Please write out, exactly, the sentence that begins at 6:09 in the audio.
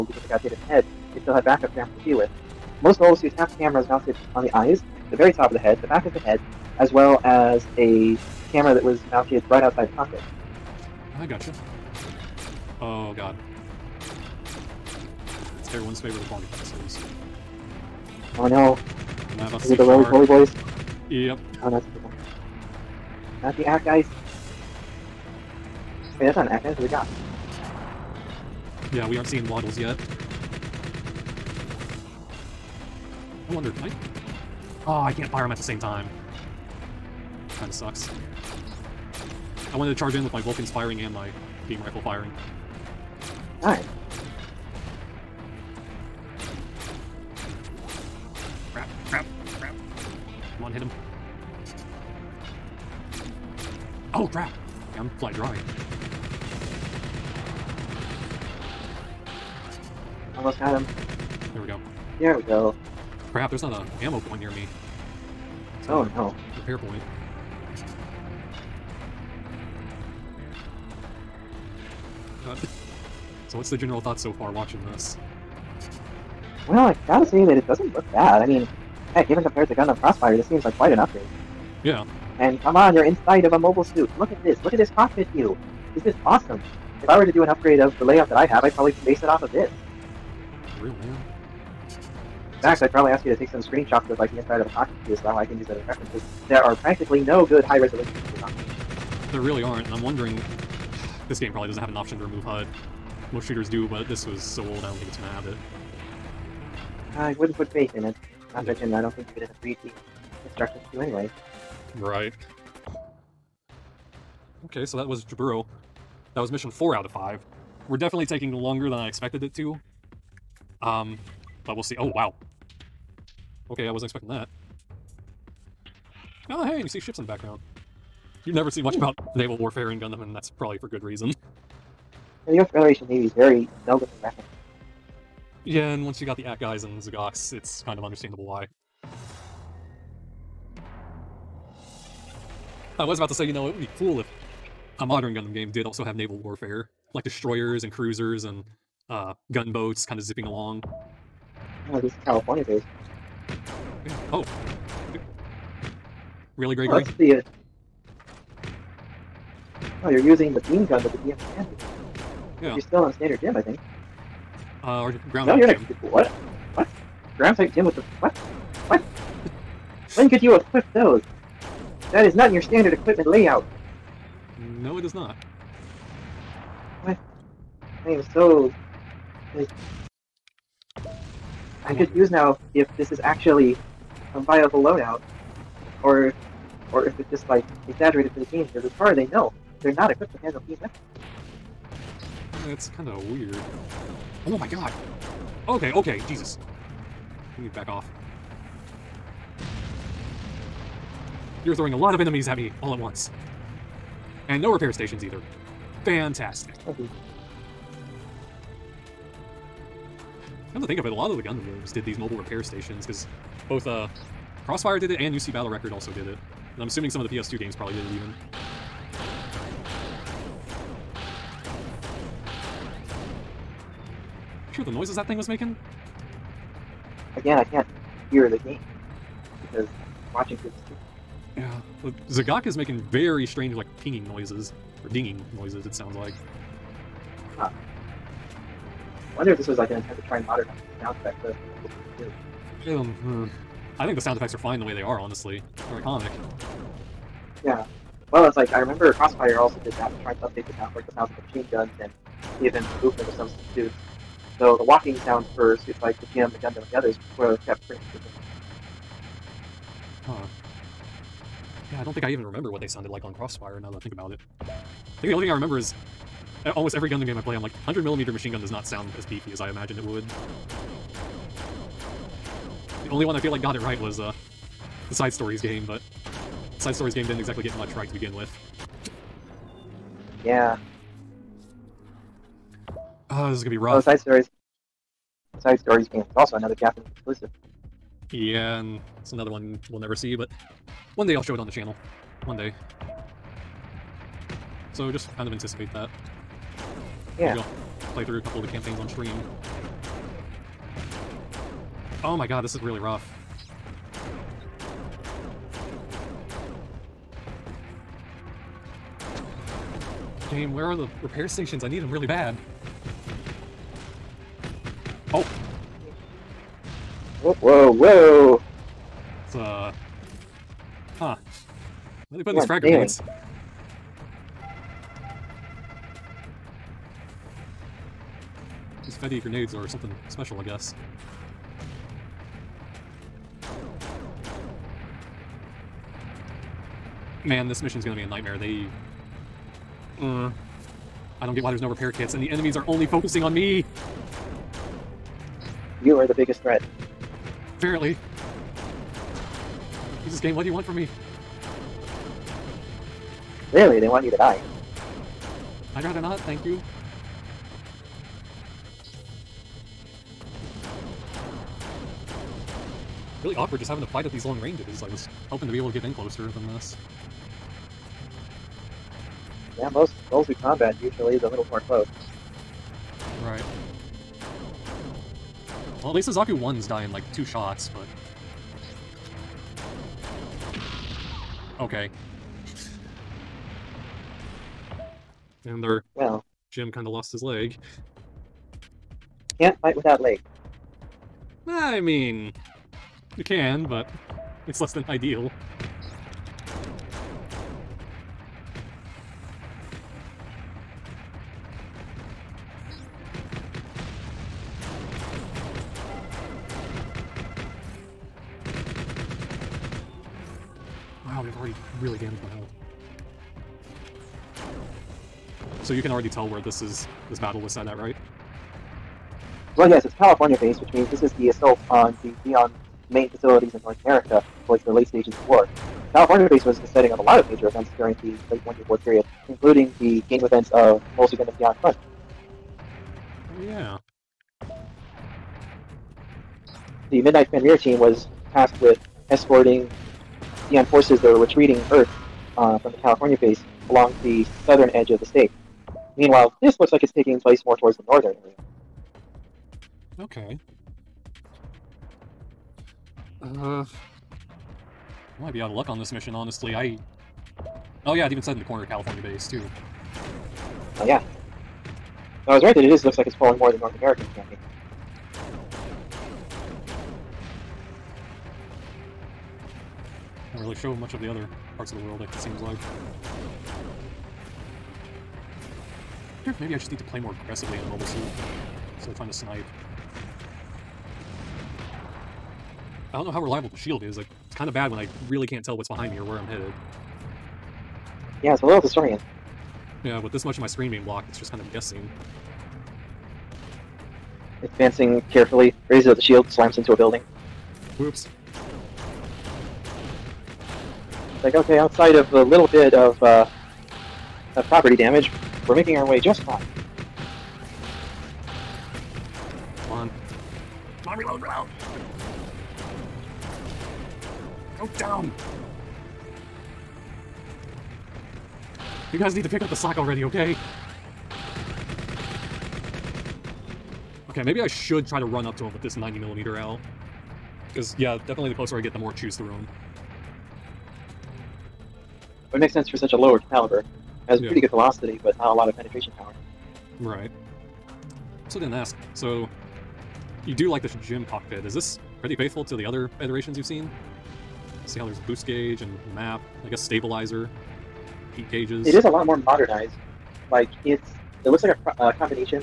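Yeah, most goals through combat usually is a little more close.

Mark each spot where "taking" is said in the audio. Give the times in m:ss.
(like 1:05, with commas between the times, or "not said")
1:58, 7:27.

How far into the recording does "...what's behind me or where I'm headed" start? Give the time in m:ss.
8:05.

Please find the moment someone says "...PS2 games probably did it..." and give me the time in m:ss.
3:37.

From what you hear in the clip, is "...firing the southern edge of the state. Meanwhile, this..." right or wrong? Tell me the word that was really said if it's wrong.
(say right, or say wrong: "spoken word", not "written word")
wrong: "along", not "firing".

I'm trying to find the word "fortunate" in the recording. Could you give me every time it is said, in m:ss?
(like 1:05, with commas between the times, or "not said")
not said.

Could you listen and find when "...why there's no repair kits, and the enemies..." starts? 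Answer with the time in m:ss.
5:41.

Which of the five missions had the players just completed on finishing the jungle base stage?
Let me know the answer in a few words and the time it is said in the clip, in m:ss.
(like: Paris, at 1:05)
4, at 1:56.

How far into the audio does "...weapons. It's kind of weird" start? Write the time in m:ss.
3:10.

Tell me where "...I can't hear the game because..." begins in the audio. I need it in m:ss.
3:47.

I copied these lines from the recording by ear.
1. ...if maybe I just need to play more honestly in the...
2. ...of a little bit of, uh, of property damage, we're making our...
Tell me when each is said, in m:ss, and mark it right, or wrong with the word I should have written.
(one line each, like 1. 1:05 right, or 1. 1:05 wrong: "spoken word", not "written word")
1. 7:56 wrong: "aggressively", not "honestly"
2. 8:22 right.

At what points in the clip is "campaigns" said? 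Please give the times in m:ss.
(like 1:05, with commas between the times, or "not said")
4:58, 7:44.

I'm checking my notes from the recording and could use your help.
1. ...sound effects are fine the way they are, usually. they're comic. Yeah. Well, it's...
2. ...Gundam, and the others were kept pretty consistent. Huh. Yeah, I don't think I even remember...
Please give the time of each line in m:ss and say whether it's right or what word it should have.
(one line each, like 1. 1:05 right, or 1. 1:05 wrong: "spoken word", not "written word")
1. 4:04 wrong: "honestly", not "usually"
2. 4:16 right.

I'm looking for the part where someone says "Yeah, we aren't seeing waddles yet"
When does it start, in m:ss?
0:28.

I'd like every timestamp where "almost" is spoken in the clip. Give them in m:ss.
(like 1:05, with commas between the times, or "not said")
1:00, 4:26.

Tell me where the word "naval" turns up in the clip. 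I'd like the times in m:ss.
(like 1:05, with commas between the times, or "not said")
2:09, 2:26.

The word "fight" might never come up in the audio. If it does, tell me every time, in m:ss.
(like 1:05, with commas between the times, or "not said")
6:04, 6:29.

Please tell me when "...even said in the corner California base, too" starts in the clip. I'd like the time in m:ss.
7:38.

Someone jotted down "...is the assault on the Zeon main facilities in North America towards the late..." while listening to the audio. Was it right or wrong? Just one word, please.
right.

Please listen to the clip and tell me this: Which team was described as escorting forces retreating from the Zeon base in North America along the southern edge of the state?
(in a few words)
Midnight Fenrir.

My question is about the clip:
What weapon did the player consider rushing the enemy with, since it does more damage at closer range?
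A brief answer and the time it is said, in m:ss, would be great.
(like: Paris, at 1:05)
90 millimeter, at 8:45.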